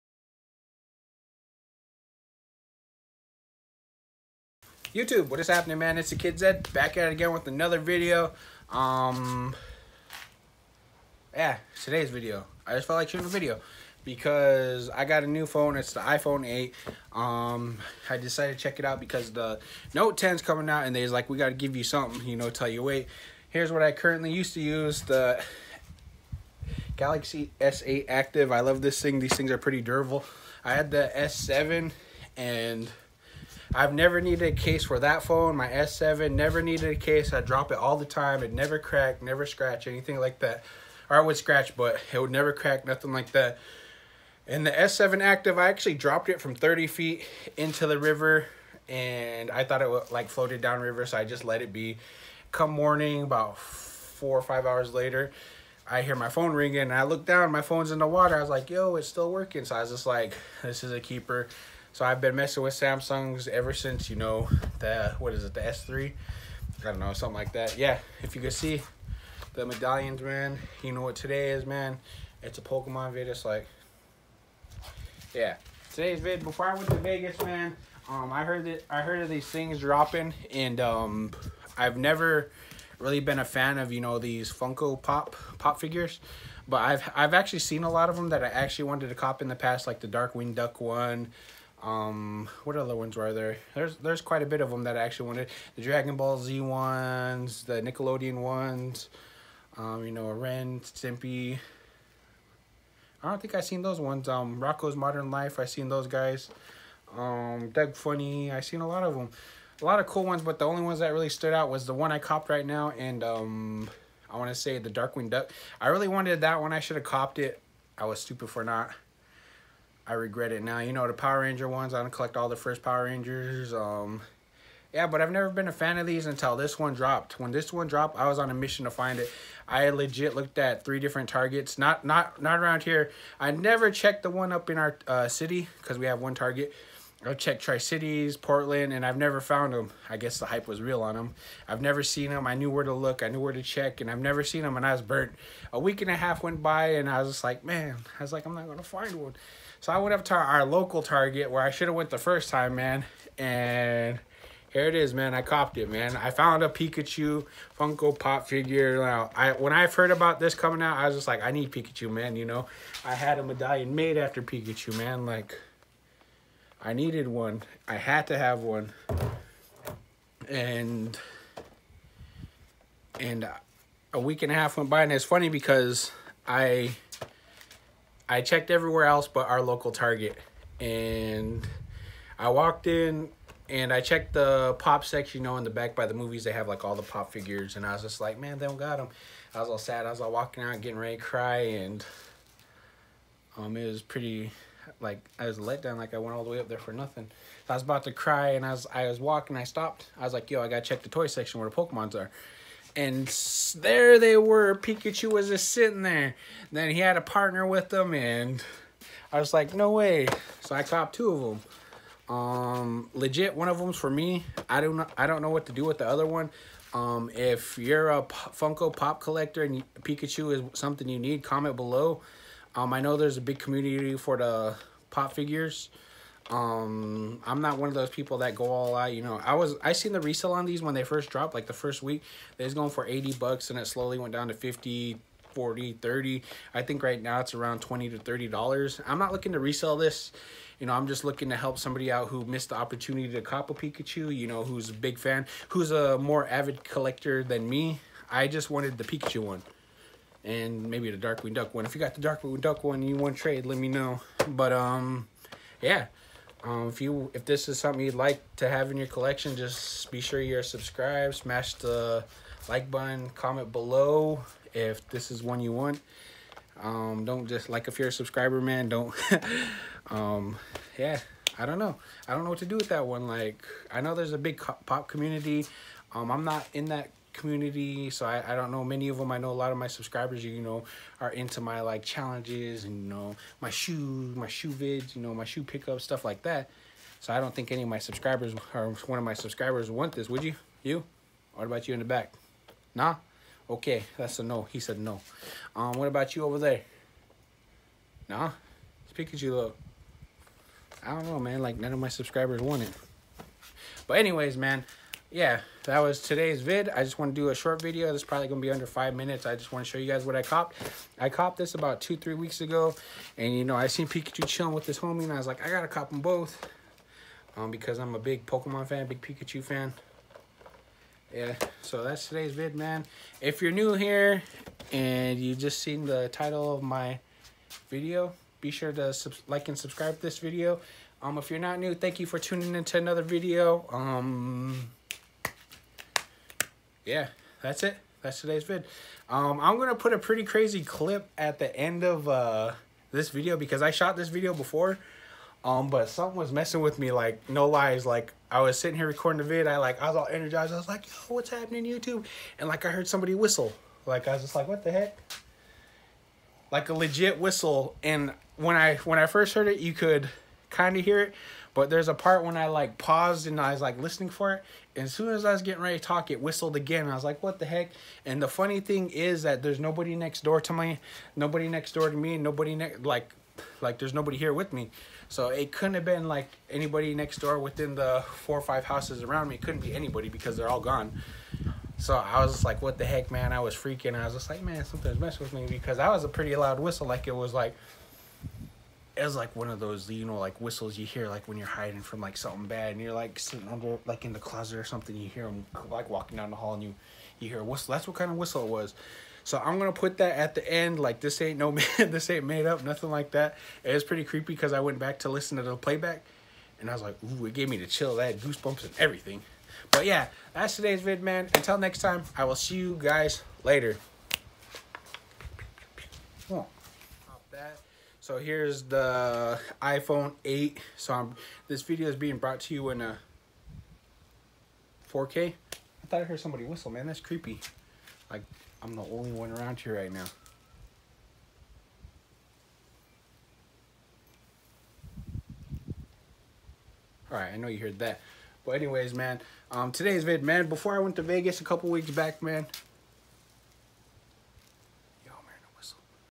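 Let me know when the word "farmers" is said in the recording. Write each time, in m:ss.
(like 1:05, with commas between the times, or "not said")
not said.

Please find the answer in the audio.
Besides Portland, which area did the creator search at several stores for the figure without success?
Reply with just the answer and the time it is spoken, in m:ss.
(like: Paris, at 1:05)
Tri Cities, at 2:17.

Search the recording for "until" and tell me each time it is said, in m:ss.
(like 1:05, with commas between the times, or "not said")
2:06, 6:51.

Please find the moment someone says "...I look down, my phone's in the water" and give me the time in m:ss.
0:56.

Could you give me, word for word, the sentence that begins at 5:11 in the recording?
I copped this about two, three weeks ago.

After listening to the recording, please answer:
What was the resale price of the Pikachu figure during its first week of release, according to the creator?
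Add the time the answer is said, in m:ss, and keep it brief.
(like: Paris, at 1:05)
$80, at 3:53.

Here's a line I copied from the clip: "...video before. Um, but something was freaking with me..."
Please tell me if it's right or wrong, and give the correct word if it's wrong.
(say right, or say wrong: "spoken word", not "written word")
wrong: "messing", not "freaking".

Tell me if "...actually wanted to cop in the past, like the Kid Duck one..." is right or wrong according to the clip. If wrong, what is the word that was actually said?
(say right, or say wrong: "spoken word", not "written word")
wrong: "Darkwing", not "Kid".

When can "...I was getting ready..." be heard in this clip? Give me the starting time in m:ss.
6:05.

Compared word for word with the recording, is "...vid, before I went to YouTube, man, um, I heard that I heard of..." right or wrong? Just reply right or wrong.
wrong.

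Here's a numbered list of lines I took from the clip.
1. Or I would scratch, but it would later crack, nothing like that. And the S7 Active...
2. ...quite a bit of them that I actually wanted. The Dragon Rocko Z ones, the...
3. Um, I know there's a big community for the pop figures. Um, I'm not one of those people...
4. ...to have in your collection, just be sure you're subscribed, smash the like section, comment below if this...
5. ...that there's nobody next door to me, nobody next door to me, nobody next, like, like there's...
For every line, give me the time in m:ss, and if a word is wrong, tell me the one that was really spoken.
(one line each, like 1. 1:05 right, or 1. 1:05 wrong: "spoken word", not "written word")
1. 0:41 wrong: "never", not "later"
2. 1:34 wrong: "Ball", not "Rocko"
3. 3:42 right
4. 4:18 wrong: "button", not "section"
5. 6:09 right.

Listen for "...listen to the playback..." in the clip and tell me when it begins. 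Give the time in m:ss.
6:45.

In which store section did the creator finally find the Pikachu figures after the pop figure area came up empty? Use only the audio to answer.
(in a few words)
toy section.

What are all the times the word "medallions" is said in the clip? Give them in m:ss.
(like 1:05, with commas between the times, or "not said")
1:09, 2:43.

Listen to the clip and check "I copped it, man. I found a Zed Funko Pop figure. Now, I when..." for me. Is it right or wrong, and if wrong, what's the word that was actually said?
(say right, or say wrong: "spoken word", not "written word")
wrong: "Pikachu", not "Zed".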